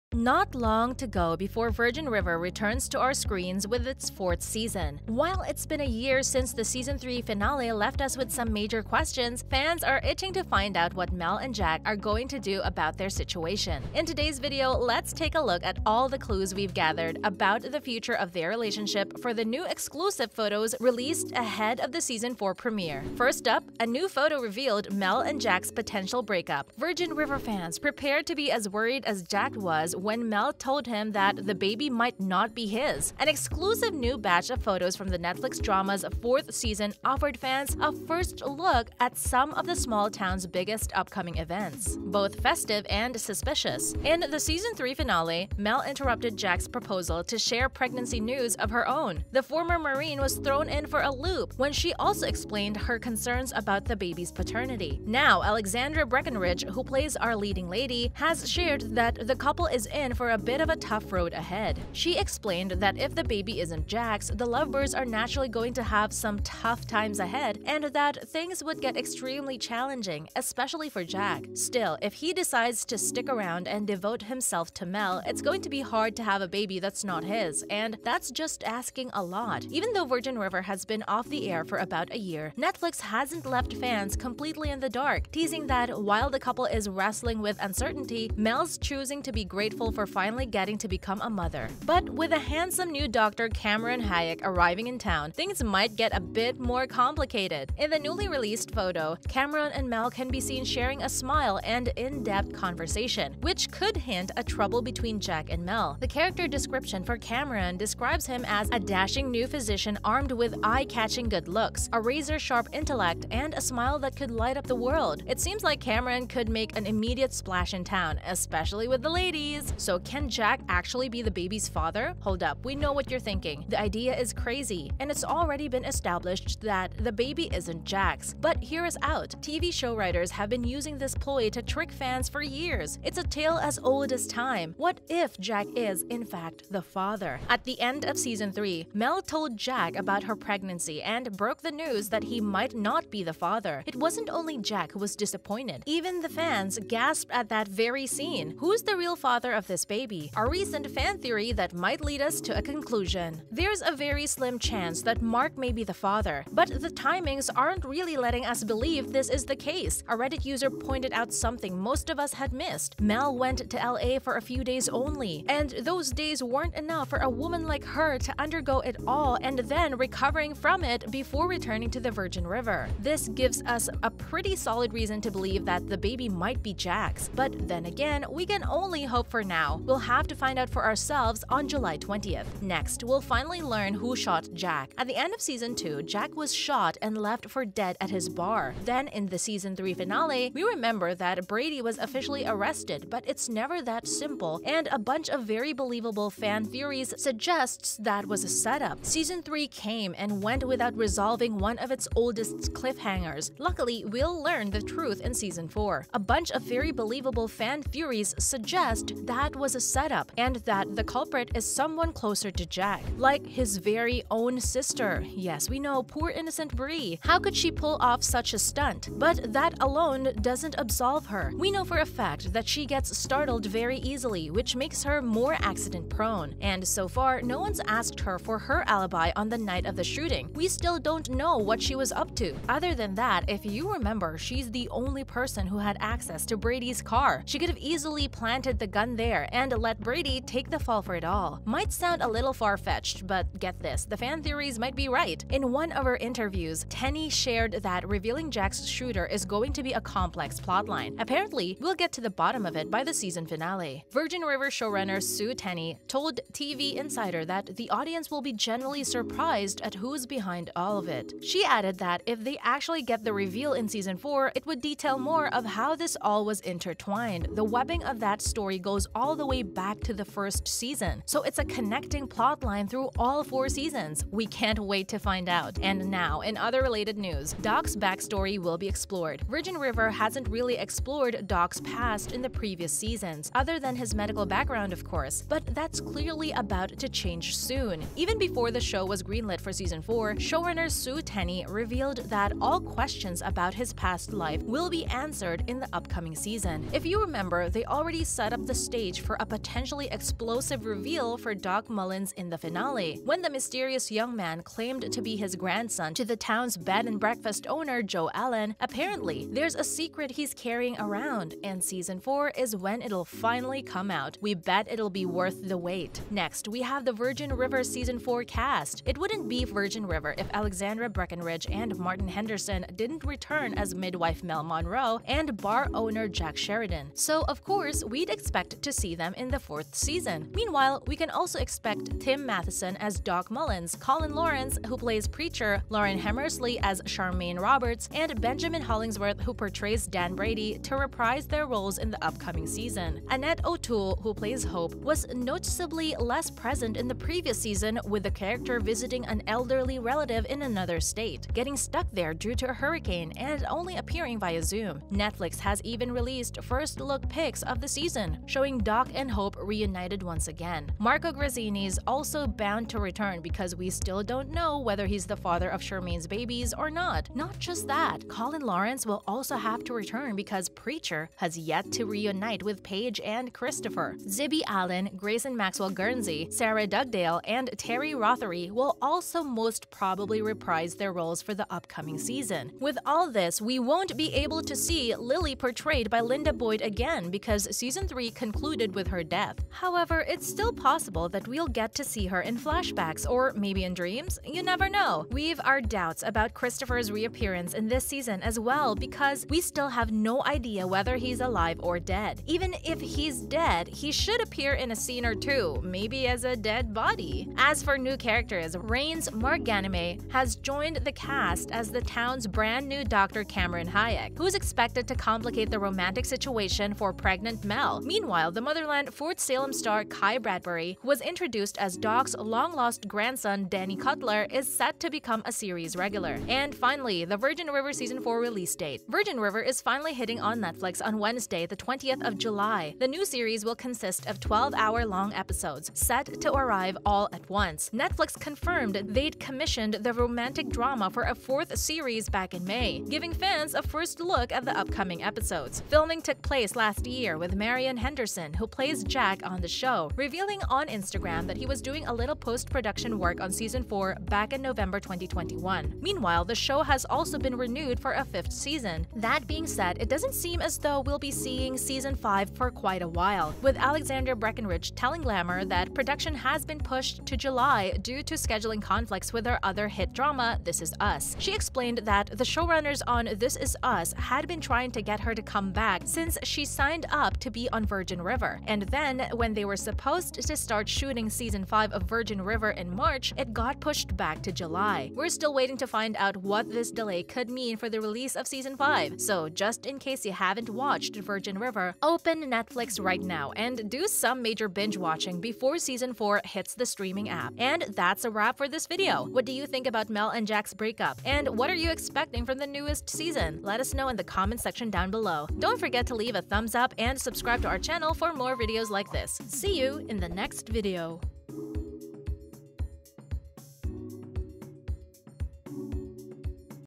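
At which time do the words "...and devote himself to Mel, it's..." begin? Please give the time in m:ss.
1:13.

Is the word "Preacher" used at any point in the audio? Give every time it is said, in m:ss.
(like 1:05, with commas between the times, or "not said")
5:35, 6:10.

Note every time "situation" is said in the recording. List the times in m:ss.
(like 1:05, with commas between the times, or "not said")
0:13, 6:56.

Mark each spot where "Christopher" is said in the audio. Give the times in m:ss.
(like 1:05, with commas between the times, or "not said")
6:13, 6:36.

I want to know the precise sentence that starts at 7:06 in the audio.
And finally, the Virgin River Season 4 release date.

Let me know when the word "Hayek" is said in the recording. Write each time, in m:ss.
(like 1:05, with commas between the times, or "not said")
1:34, 6:53.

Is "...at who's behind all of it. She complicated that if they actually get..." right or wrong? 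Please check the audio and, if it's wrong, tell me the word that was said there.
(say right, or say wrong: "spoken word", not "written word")
wrong: "added", not "complicated".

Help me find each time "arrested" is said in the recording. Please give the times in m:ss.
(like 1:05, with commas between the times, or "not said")
3:12.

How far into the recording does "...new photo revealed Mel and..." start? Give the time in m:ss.
0:23.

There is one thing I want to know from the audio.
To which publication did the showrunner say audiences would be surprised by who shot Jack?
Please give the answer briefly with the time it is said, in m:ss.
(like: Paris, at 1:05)
TV Insider, at 4:16.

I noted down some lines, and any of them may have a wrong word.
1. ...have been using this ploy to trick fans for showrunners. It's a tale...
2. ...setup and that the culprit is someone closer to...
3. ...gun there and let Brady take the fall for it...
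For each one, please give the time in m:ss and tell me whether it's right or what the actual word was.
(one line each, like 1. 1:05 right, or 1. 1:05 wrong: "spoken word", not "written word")
1. 2:10 wrong: "years", not "showrunners"
2. 3:29 right
3. 3:58 right.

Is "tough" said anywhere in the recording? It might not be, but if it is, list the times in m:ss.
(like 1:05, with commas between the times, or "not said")
1:00, 1:06.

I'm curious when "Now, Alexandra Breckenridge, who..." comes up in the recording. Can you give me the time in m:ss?
0:55.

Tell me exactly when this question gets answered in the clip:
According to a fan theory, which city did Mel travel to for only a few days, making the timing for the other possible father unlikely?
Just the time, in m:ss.
2:43.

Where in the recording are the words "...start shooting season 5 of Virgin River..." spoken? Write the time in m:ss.
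8:00.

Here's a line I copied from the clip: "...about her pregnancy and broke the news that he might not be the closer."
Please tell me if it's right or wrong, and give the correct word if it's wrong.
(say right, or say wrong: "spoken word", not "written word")
wrong: "father", not "closer".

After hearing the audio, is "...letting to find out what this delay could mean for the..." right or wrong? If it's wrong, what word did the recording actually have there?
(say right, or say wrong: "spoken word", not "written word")
wrong: "waiting", not "letting".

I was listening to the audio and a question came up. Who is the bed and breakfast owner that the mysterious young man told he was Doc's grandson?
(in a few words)
Jo Ellen.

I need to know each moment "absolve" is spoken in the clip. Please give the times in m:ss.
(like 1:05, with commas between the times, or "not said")
3:40.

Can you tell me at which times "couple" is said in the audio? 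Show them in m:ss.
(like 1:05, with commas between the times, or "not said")
0:59, 1:26.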